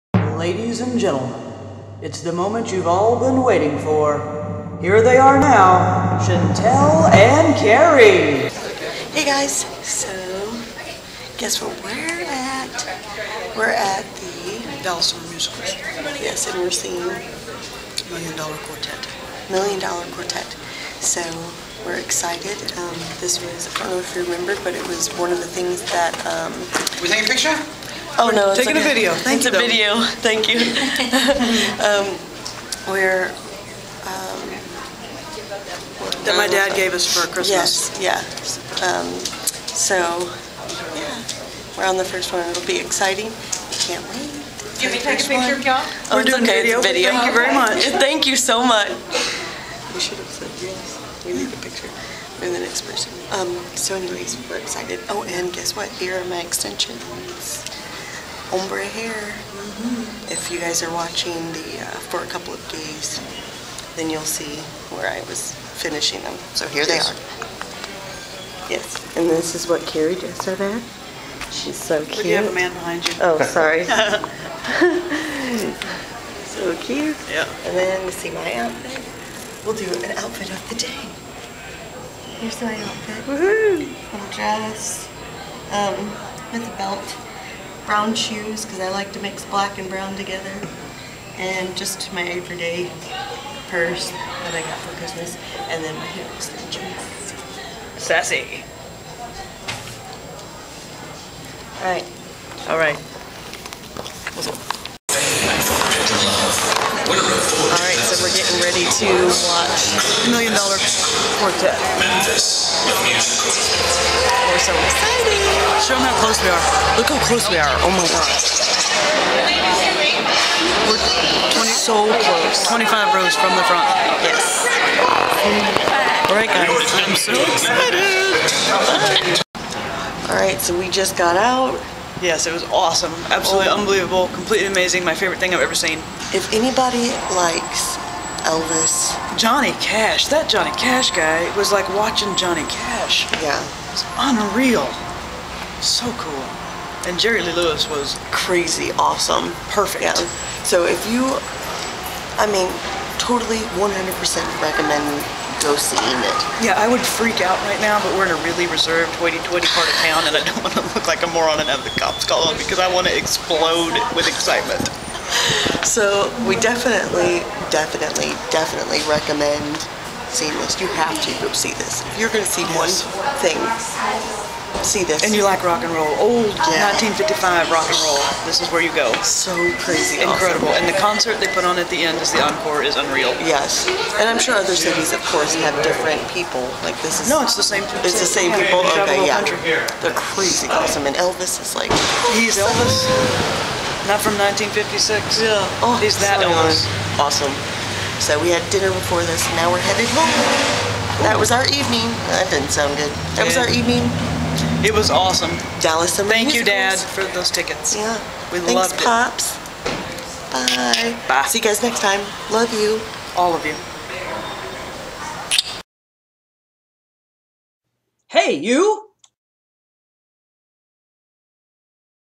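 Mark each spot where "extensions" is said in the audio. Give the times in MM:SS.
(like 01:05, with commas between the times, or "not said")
00:56, 01:36.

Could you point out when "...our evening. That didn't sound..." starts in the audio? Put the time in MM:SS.
03:21.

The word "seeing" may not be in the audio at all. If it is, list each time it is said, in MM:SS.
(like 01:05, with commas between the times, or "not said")
00:16, 02:35, 02:50.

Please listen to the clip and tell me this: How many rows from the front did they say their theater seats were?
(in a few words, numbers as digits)
25.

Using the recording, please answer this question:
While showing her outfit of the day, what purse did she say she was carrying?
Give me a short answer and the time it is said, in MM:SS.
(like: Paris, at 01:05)
Everyday purse, at 01:32.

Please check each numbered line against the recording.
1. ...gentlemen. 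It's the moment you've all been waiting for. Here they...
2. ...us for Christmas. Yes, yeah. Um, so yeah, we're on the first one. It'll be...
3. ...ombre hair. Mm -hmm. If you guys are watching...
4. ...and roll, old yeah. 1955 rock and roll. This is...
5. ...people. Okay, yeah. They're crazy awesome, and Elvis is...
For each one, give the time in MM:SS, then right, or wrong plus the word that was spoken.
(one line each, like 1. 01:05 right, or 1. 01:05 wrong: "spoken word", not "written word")
1. 00:00 right
2. 00:36 right
3. 00:58 right
4. 02:55 right
5. 03:08 right.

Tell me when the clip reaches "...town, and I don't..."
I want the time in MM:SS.
02:40.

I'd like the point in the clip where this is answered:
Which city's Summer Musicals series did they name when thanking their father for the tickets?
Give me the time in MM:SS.
03:25.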